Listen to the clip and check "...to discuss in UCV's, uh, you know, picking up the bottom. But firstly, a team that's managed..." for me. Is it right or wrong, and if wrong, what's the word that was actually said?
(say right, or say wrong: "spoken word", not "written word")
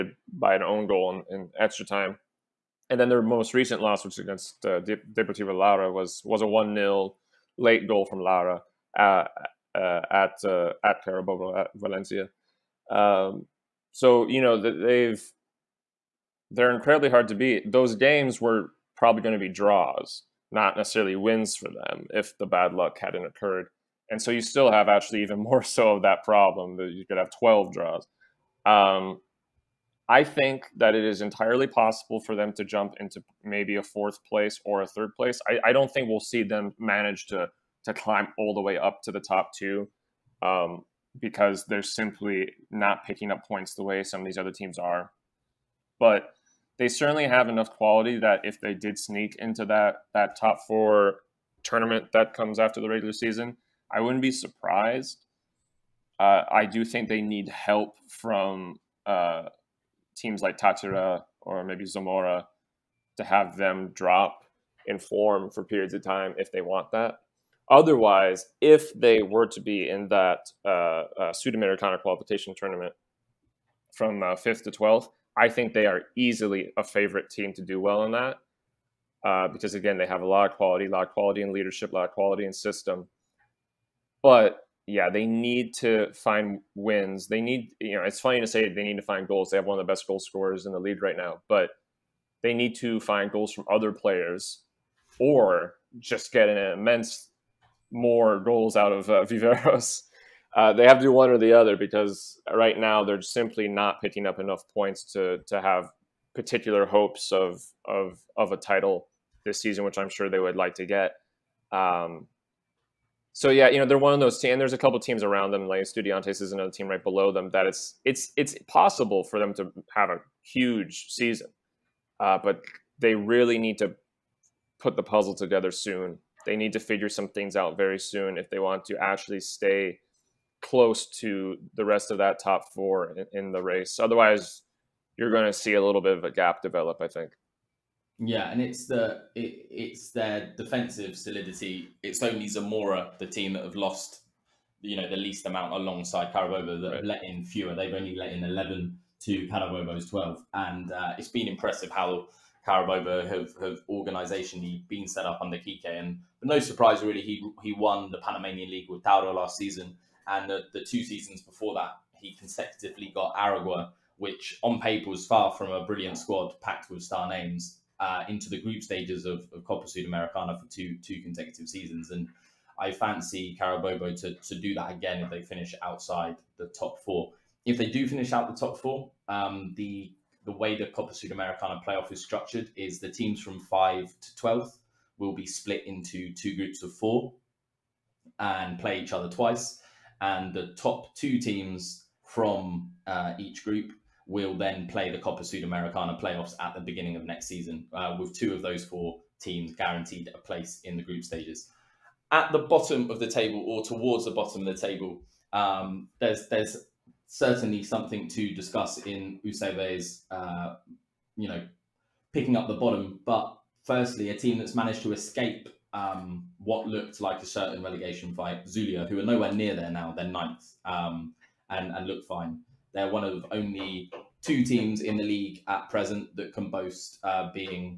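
right.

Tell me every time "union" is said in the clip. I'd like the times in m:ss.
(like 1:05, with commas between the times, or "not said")
not said.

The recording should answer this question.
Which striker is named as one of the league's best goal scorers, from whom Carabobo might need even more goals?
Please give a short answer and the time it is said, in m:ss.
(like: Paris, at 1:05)
Viveros, at 1:39.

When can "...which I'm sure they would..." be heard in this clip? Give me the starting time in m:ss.
1:49.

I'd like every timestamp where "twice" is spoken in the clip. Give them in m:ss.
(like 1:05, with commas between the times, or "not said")
3:09.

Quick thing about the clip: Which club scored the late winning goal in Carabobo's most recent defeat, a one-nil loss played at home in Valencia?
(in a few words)
Deportivo Lara.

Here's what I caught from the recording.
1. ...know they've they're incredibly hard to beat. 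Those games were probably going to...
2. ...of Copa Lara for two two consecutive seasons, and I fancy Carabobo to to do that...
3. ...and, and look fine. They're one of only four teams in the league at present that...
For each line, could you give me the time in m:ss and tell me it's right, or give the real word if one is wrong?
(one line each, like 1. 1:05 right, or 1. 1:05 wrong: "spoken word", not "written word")
1. 0:14 right
2. 2:49 wrong: "Sudamericana", not "Lara"
3. 3:41 wrong: "two", not "four".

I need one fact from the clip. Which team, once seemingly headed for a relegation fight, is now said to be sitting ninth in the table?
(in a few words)
Zulia.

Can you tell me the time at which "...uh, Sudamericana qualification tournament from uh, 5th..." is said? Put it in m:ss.
1:11.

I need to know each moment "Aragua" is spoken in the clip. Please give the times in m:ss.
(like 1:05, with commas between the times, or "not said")
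2:43.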